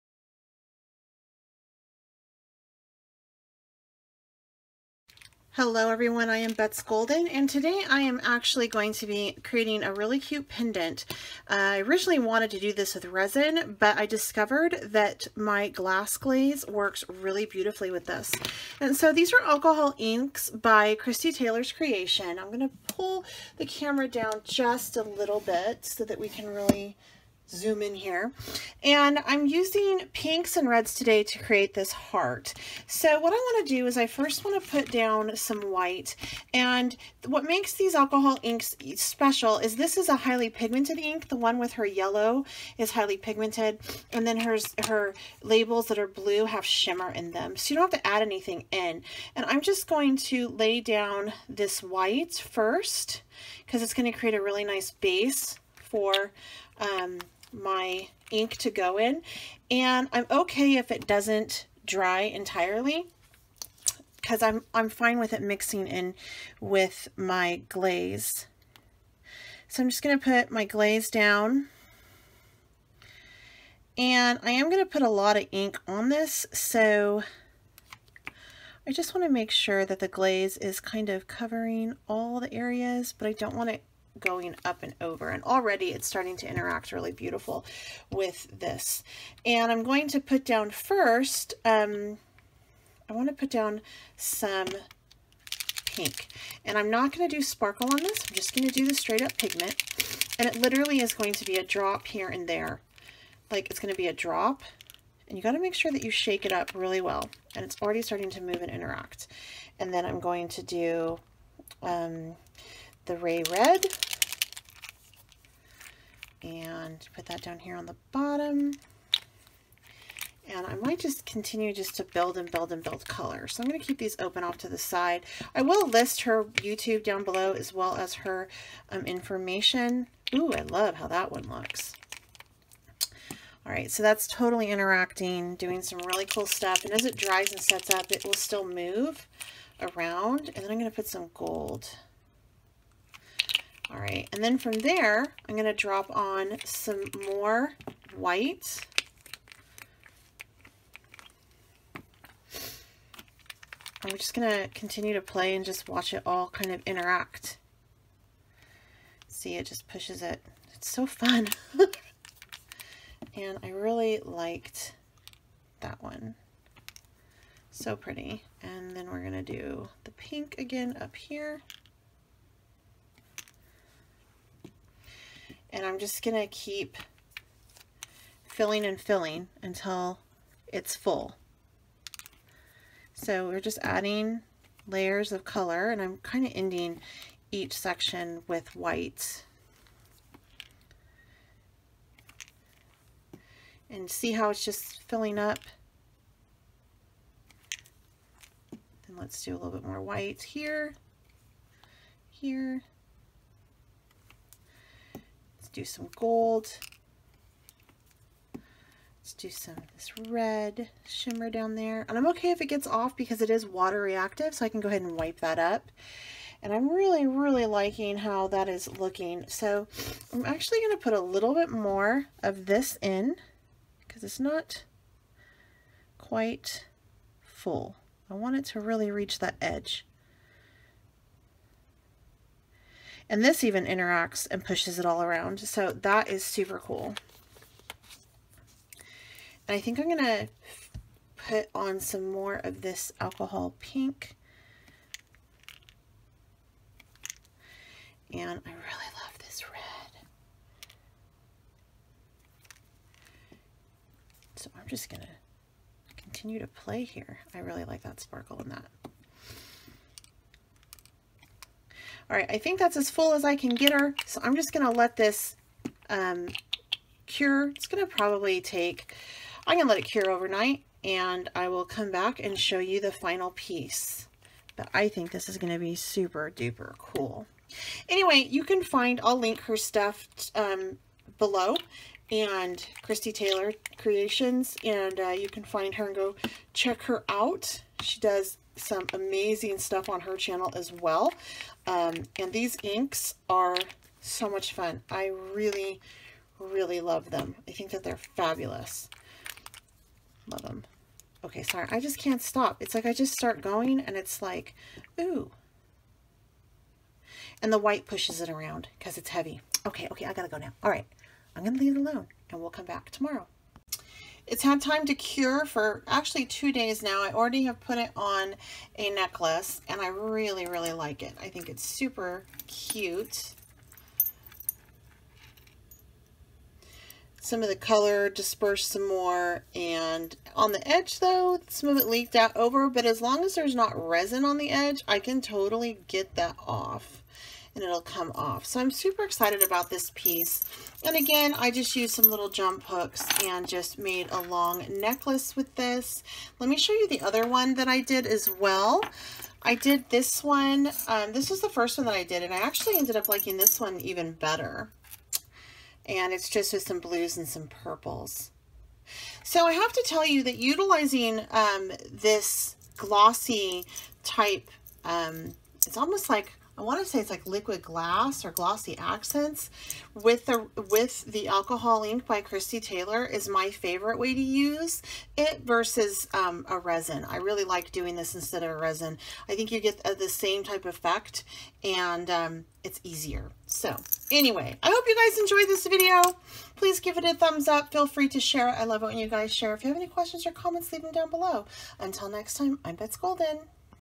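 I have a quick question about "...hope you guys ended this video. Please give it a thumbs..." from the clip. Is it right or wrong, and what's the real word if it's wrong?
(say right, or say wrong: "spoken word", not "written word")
wrong: "enjoyed", not "ended".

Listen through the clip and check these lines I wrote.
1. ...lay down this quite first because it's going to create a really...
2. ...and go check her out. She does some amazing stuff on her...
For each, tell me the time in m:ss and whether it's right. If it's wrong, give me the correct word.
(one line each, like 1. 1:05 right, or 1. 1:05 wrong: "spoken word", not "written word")
1. 0:50 wrong: "white", not "quite"
2. 4:46 right.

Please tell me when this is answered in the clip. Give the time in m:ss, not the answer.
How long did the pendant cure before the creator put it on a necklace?
5:16.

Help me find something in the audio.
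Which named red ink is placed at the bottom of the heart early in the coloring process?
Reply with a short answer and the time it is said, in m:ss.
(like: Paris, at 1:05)
Ray Red, at 1:53.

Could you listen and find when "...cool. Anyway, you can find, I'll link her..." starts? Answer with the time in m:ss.
4:36.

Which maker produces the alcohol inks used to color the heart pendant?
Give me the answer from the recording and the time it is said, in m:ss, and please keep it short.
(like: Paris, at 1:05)
Kristie Taylor's Creation, at 0:20.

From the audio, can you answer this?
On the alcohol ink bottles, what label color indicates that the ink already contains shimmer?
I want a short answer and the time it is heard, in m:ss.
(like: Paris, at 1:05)
Blue, at 0:46.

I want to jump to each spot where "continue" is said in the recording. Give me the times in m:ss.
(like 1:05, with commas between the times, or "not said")
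2:01, 2:34, 4:16.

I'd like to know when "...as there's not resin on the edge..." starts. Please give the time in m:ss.
5:33.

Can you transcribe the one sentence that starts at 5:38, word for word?
So I'm super excited about this piece.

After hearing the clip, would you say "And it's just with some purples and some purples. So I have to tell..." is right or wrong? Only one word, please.
wrong.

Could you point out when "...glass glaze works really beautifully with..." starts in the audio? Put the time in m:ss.
0:15.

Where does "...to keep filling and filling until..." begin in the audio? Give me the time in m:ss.
2:56.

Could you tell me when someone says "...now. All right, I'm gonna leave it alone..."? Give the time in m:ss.
5:10.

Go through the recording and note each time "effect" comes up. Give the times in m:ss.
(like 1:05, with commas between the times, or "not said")
6:20.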